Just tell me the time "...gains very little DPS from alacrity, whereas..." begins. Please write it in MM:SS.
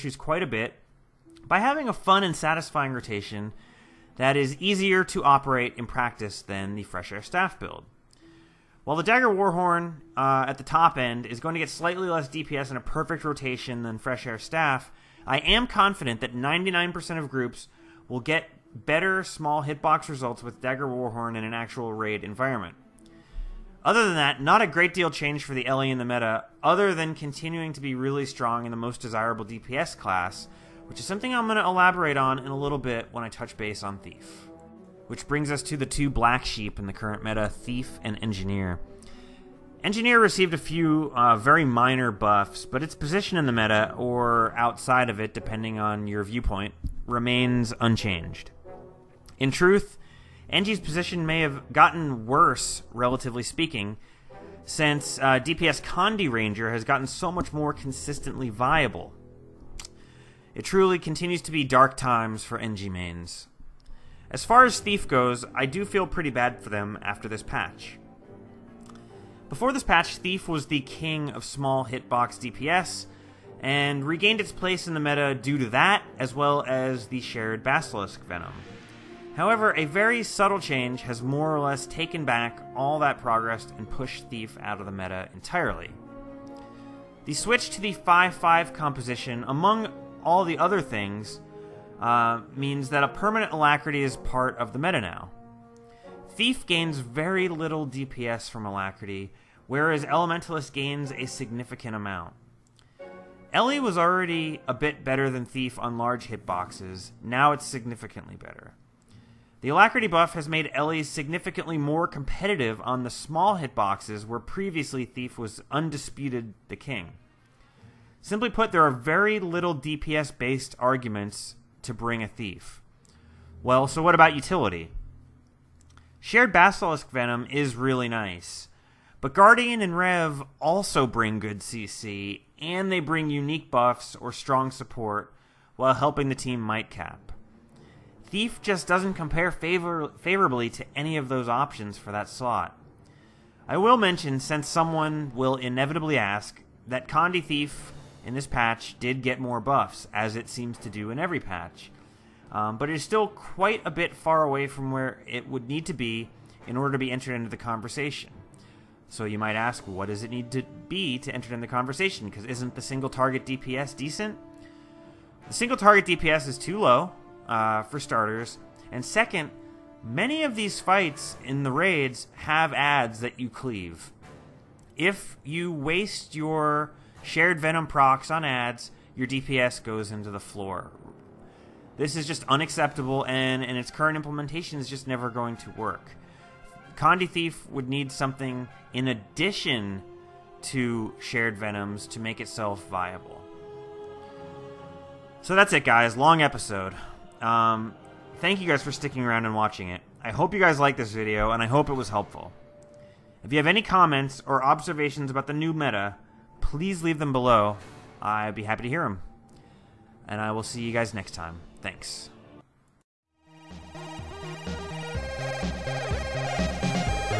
01:36.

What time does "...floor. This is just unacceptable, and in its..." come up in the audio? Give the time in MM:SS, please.
03:00.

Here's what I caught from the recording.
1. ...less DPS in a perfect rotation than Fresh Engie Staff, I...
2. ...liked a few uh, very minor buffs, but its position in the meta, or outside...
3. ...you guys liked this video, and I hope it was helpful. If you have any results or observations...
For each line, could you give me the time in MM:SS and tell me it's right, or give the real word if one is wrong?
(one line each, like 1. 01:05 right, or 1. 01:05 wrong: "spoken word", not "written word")
1. 00:12 wrong: "Air", not "Engie"
2. 00:40 wrong: "received", not "liked"
3. 03:20 wrong: "comments", not "results".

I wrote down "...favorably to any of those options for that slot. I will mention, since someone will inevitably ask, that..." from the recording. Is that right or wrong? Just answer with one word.
right.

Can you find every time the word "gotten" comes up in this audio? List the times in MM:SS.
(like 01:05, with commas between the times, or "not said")
00:51, 00:56.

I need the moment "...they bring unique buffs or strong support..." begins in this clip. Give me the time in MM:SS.
02:12.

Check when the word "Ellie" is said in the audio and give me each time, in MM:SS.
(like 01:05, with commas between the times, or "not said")
00:25, 01:43, 01:50.